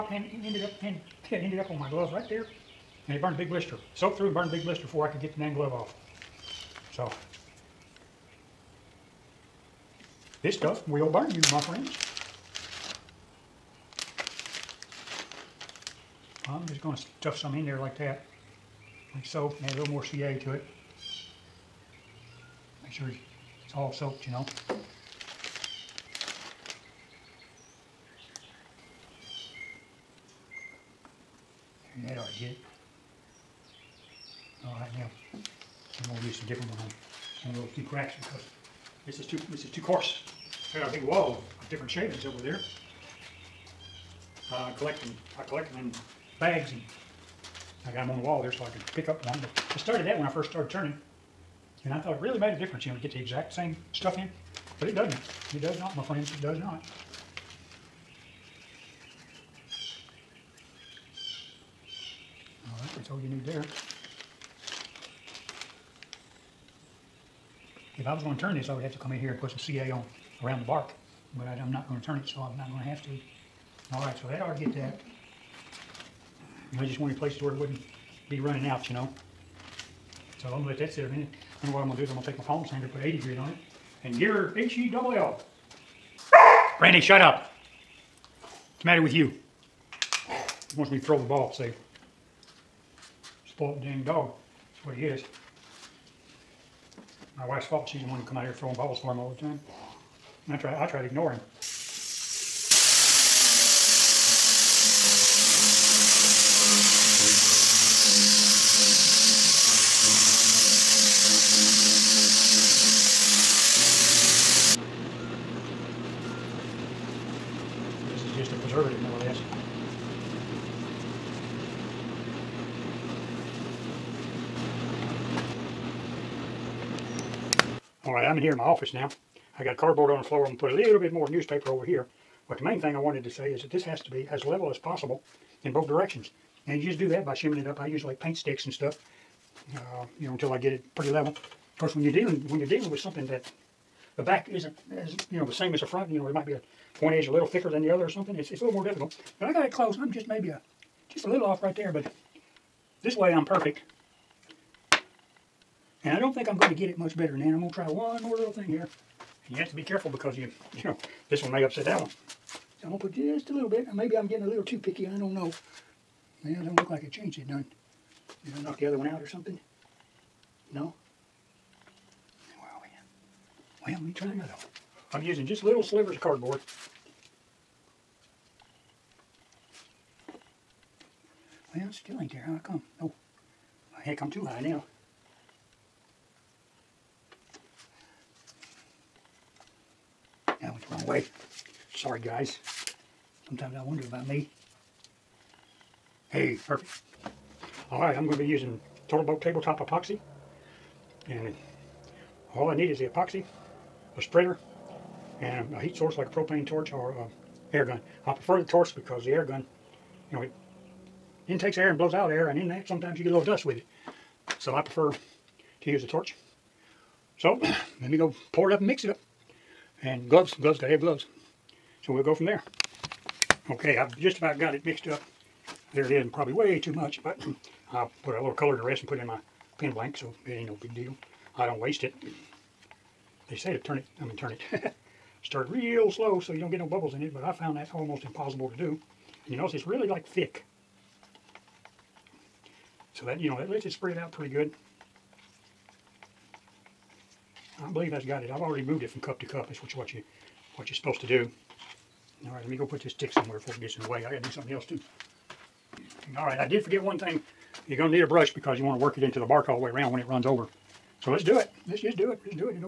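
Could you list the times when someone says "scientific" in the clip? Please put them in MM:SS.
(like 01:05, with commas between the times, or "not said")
not said.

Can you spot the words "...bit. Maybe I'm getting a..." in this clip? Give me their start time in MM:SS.
02:43.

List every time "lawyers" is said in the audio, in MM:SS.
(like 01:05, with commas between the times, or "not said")
not said.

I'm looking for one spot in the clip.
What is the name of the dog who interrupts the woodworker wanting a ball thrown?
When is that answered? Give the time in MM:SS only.
01:26.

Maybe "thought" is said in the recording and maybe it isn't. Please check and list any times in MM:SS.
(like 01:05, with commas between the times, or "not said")
00:52.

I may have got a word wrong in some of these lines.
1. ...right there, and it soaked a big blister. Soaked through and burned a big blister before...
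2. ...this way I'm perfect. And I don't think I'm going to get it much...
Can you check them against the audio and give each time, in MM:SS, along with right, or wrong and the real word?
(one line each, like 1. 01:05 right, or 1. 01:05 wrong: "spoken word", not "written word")
1. 00:02 wrong: "burned", not "soaked"
2. 02:33 right.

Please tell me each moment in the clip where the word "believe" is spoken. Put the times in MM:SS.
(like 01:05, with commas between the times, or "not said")
04:07.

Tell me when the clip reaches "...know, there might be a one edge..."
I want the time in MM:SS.
02:26.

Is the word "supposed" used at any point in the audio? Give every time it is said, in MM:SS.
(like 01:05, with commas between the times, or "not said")
04:10.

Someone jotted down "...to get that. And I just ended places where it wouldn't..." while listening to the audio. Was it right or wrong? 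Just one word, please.
wrong.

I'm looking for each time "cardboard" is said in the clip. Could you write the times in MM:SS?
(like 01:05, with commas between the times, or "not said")
02:09, 02:56.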